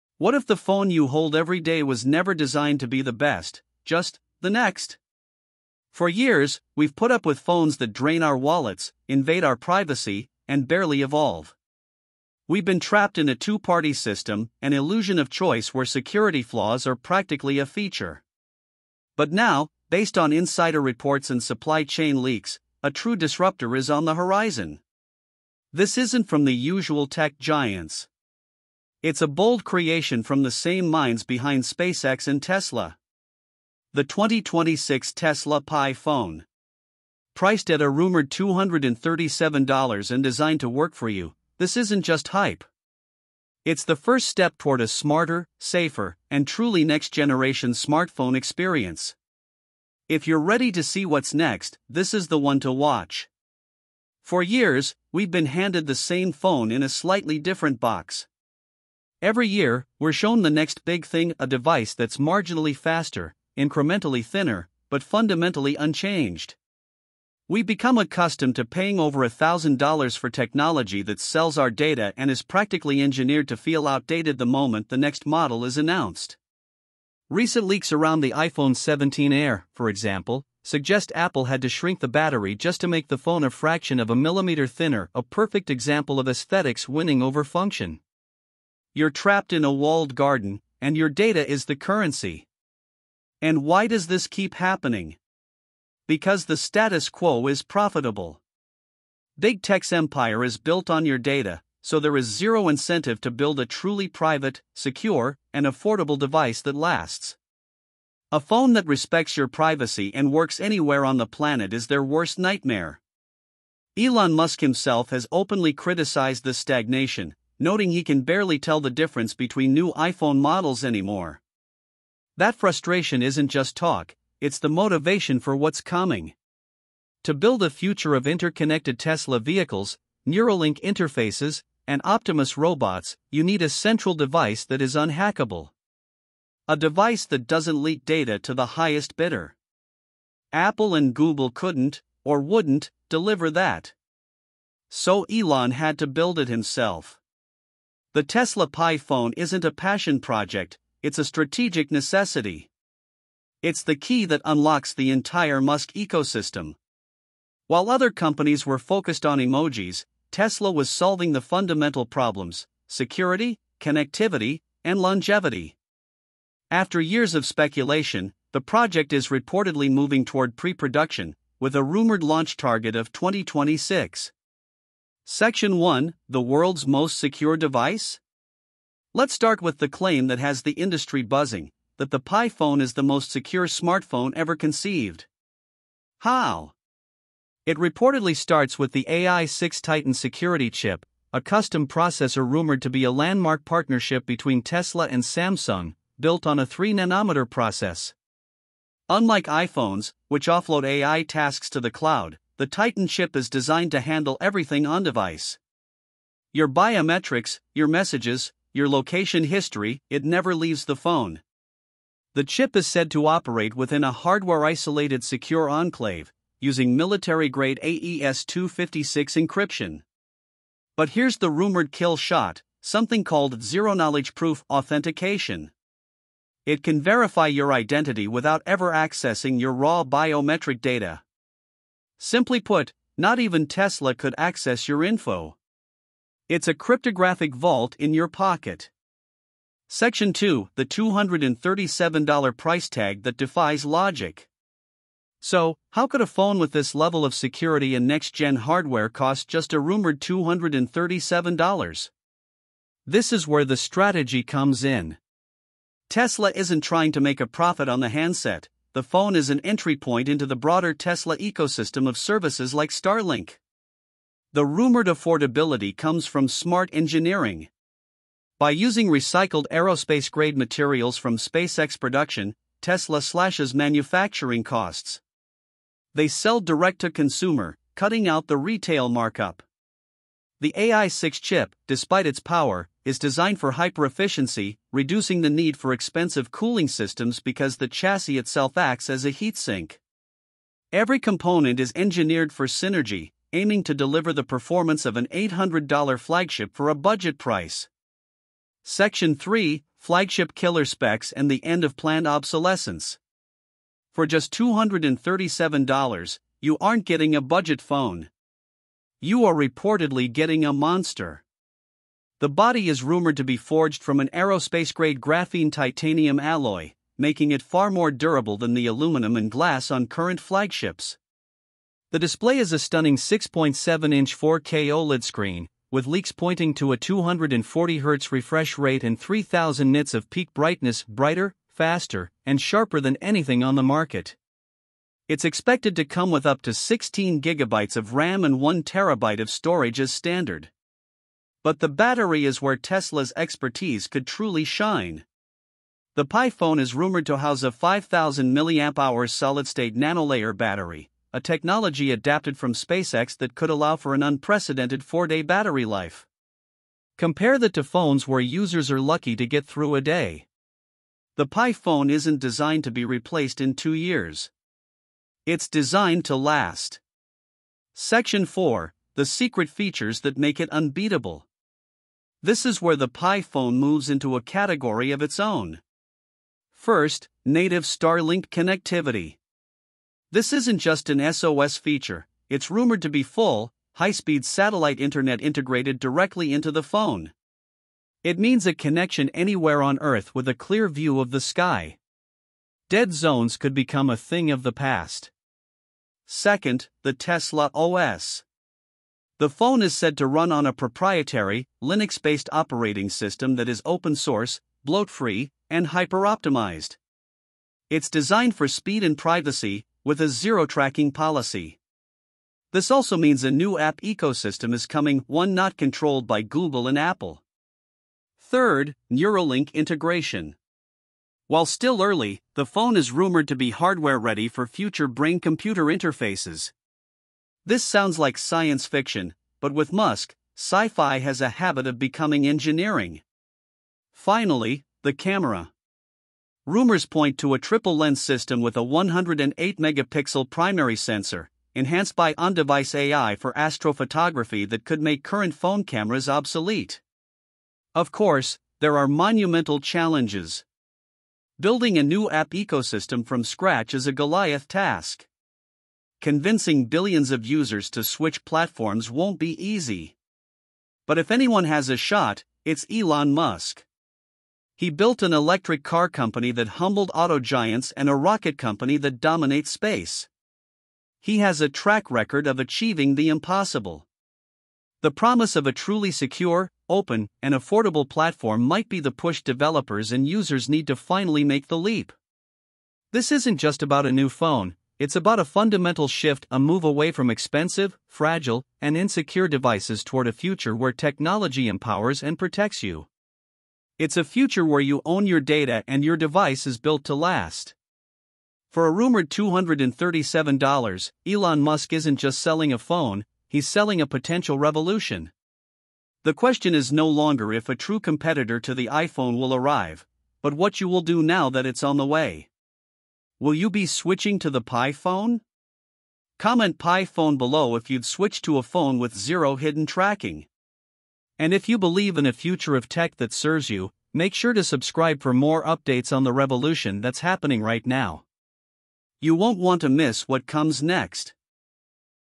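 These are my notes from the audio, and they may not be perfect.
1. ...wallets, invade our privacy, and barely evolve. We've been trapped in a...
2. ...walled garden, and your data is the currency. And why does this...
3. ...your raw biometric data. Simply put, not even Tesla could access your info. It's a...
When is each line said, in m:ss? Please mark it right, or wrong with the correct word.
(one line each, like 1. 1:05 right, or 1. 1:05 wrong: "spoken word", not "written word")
1. 0:08 right
2. 1:29 right
3. 3:49 right.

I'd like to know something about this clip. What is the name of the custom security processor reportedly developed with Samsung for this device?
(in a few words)
AI6 Titan.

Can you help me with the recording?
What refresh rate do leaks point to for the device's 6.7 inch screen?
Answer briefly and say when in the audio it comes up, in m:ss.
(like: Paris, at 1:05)
240Hz, at 5:26.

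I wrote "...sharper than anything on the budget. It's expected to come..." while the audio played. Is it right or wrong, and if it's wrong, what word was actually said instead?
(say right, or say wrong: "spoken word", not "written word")
wrong: "market", not "budget".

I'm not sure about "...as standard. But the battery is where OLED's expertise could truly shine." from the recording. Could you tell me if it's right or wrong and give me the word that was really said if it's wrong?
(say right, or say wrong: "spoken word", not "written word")
wrong: "Tesla", not "OLED".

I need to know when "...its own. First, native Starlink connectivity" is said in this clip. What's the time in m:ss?
6:15.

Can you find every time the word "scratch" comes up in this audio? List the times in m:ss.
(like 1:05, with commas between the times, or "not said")
7:33.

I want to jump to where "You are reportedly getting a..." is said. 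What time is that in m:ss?
5:09.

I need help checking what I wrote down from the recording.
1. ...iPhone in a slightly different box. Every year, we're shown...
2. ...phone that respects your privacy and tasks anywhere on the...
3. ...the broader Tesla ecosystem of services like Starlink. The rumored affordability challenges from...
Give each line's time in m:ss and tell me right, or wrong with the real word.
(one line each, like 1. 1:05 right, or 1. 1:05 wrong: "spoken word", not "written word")
1. 0:56 wrong: "phone", not "iPhone"
2. 1:48 wrong: "works", not "tasks"
3. 4:20 wrong: "comes", not "challenges".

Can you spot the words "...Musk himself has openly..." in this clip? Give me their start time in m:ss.
1:54.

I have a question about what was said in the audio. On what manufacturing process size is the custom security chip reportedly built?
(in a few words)
3 nanometer.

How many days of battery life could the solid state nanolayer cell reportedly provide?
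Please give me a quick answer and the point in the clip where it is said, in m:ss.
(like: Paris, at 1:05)
4, at 5:55.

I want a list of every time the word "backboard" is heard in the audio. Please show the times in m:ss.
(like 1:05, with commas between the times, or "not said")
not said.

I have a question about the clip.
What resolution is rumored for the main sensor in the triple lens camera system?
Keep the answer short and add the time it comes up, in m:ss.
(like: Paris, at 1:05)
108 megapixel, at 7:18.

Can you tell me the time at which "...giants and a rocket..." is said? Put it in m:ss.
7:47.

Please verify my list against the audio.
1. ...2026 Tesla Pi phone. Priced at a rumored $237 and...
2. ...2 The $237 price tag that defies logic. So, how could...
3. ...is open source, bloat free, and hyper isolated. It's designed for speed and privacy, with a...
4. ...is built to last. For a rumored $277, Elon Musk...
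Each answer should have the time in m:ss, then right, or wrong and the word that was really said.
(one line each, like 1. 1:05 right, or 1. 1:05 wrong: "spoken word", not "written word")
1. 0:34 right
2. 4:00 right
3. 6:43 wrong: "optimized", not "isolated"
4. 8:16 wrong: "237", not "277".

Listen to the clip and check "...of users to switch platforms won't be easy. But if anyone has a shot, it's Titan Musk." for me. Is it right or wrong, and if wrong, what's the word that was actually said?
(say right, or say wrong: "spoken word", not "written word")
wrong: "Elon", not "Titan".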